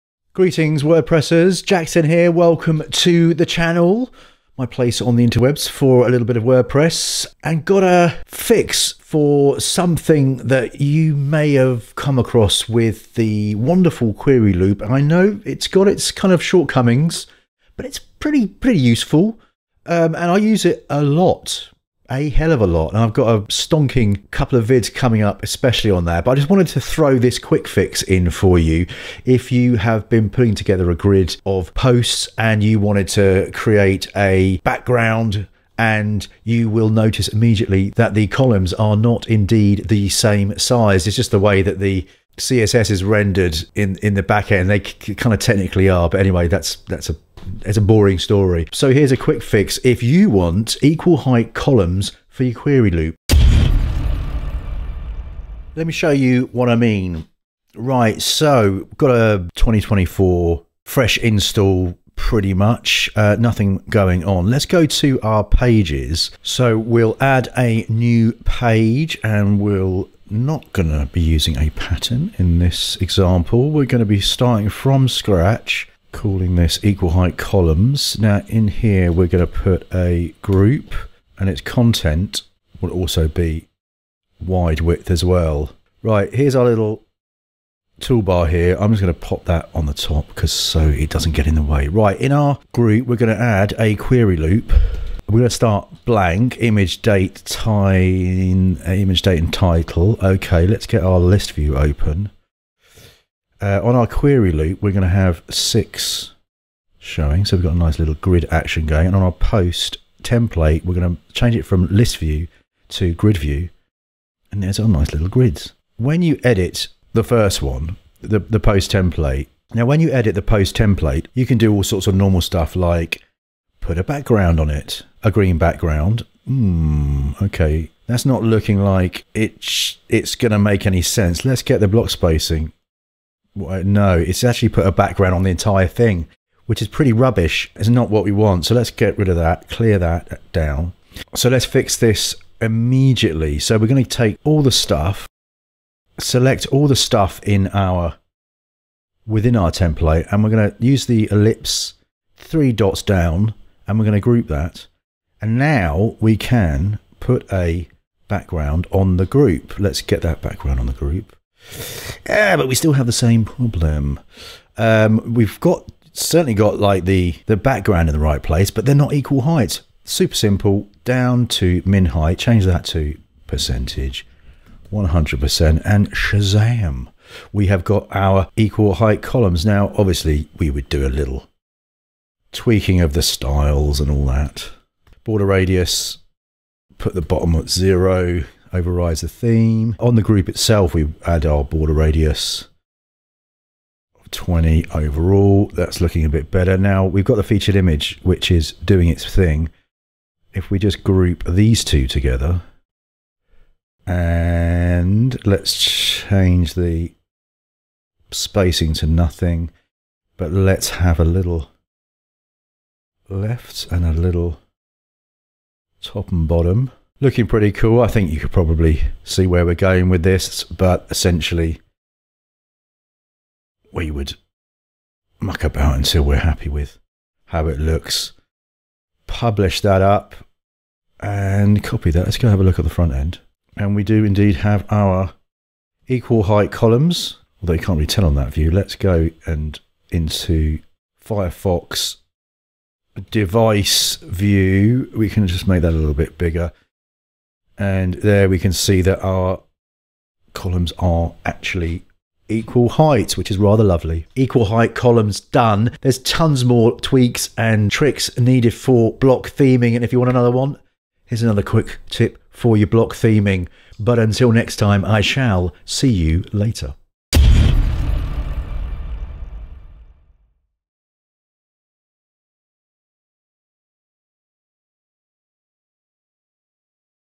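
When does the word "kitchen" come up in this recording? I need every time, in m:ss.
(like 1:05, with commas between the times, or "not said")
not said.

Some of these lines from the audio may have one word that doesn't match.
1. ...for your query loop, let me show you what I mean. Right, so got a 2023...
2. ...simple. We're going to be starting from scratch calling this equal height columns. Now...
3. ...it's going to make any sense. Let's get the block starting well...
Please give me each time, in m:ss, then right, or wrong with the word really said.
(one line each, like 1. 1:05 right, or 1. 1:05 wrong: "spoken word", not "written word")
1. 0:52 wrong: "2024", not "2023"
2. 1:12 wrong: "example", not "simple"
3. 2:10 wrong: "spacing", not "starting".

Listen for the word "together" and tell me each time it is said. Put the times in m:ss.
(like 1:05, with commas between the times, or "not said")
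0:30, 3:22.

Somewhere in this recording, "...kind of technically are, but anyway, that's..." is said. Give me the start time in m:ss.
0:44.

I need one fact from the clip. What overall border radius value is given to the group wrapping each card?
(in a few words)
20.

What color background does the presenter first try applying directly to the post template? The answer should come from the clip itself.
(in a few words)
Green.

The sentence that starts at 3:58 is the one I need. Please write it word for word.
Let's go and into Firefox device view.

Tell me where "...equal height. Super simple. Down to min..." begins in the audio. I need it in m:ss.
2:49.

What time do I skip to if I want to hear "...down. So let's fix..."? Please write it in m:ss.
2:20.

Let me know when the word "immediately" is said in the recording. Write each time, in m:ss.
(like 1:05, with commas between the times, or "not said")
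0:37, 2:22.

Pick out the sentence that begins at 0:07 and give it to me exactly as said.
And got a fix for something that you may have come across with the wonderful query loop.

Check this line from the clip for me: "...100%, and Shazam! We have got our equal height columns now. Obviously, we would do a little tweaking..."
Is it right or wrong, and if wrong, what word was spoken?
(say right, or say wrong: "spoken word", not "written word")
right.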